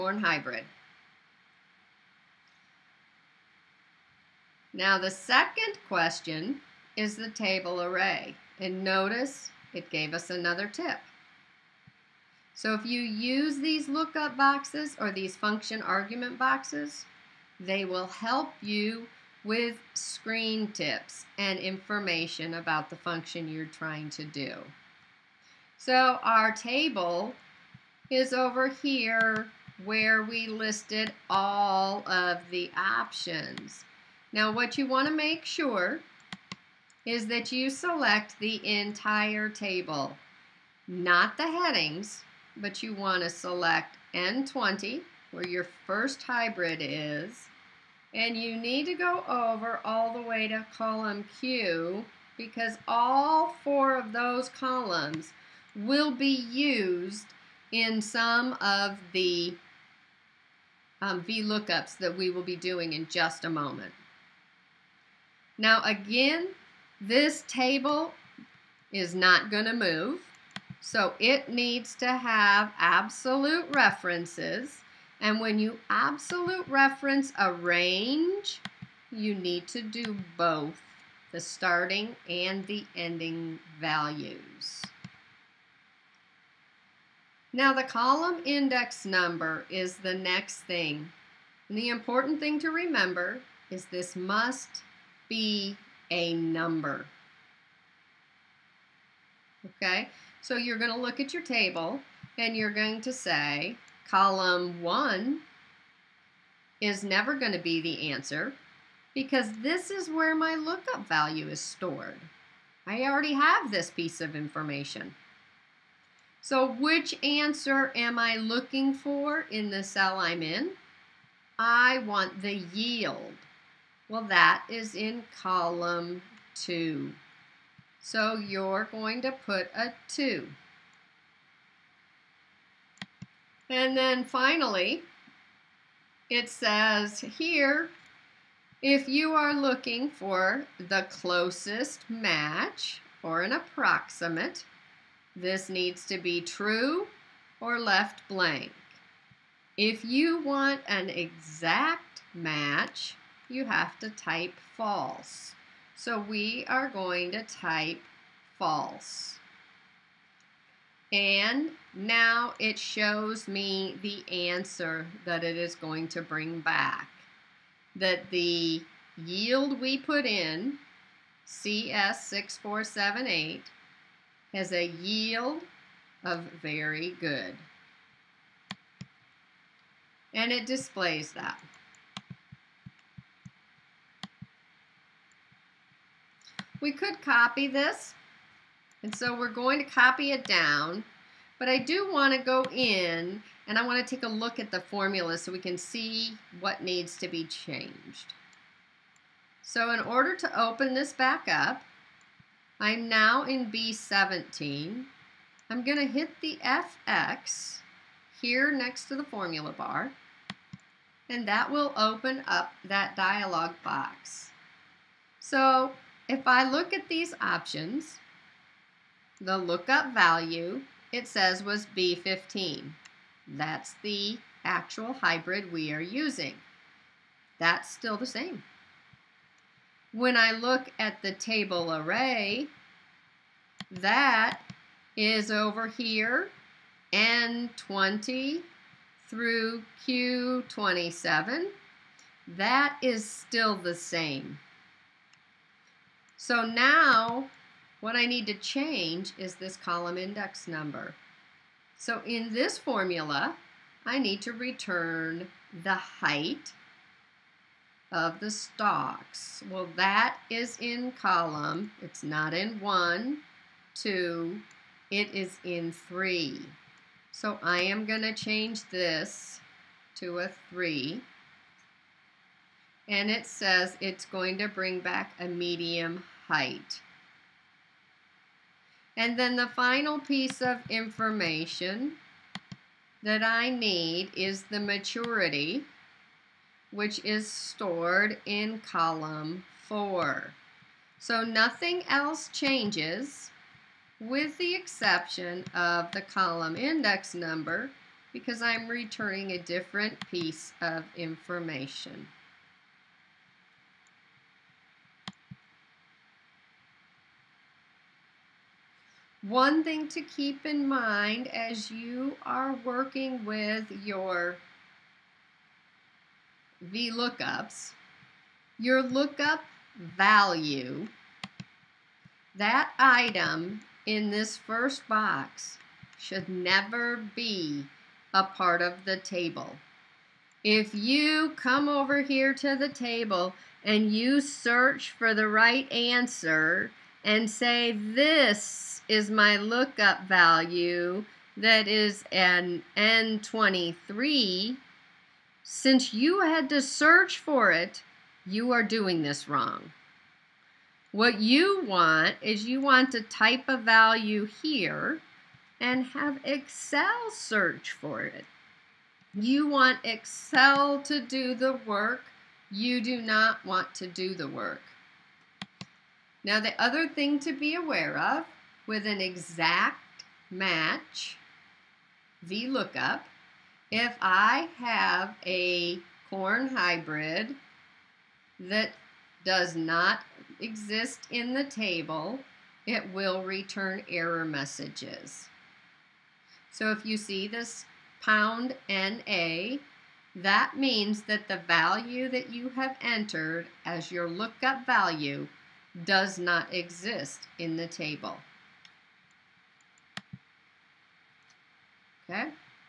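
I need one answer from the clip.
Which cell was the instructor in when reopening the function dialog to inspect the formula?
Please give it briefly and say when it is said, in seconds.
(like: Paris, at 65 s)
B17, at 203 s.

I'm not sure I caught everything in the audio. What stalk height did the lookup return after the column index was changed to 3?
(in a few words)
Medium.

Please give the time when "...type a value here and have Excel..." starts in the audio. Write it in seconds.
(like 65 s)
353 s.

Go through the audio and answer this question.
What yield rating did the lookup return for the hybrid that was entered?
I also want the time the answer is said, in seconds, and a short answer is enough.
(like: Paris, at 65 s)
Very good, at 176 s.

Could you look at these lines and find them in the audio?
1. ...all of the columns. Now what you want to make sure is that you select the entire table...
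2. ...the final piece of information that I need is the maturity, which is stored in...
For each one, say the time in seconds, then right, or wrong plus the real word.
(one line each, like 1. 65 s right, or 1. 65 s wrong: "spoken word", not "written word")
1. 31 s wrong: "options", not "columns"
2. 279 s right.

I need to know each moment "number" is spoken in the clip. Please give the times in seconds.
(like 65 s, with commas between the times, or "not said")
89 s, 96 s, 250 s, 297 s.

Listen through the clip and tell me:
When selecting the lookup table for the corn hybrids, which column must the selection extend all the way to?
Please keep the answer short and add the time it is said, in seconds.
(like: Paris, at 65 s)
Column Q, at 50 s.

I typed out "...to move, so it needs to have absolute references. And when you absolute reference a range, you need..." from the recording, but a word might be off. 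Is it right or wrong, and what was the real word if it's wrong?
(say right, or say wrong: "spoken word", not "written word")
right.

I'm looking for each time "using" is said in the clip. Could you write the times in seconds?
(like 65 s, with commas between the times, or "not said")
225 s.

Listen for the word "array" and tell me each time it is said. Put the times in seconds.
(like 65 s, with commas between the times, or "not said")
7 s, 231 s.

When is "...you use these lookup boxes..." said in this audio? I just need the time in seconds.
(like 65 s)
12 s.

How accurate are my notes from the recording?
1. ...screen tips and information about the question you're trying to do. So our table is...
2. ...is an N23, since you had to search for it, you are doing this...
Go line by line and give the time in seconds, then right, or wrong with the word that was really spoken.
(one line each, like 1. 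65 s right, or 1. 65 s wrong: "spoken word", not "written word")
1. 19 s wrong: "function", not "question"
2. 341 s right.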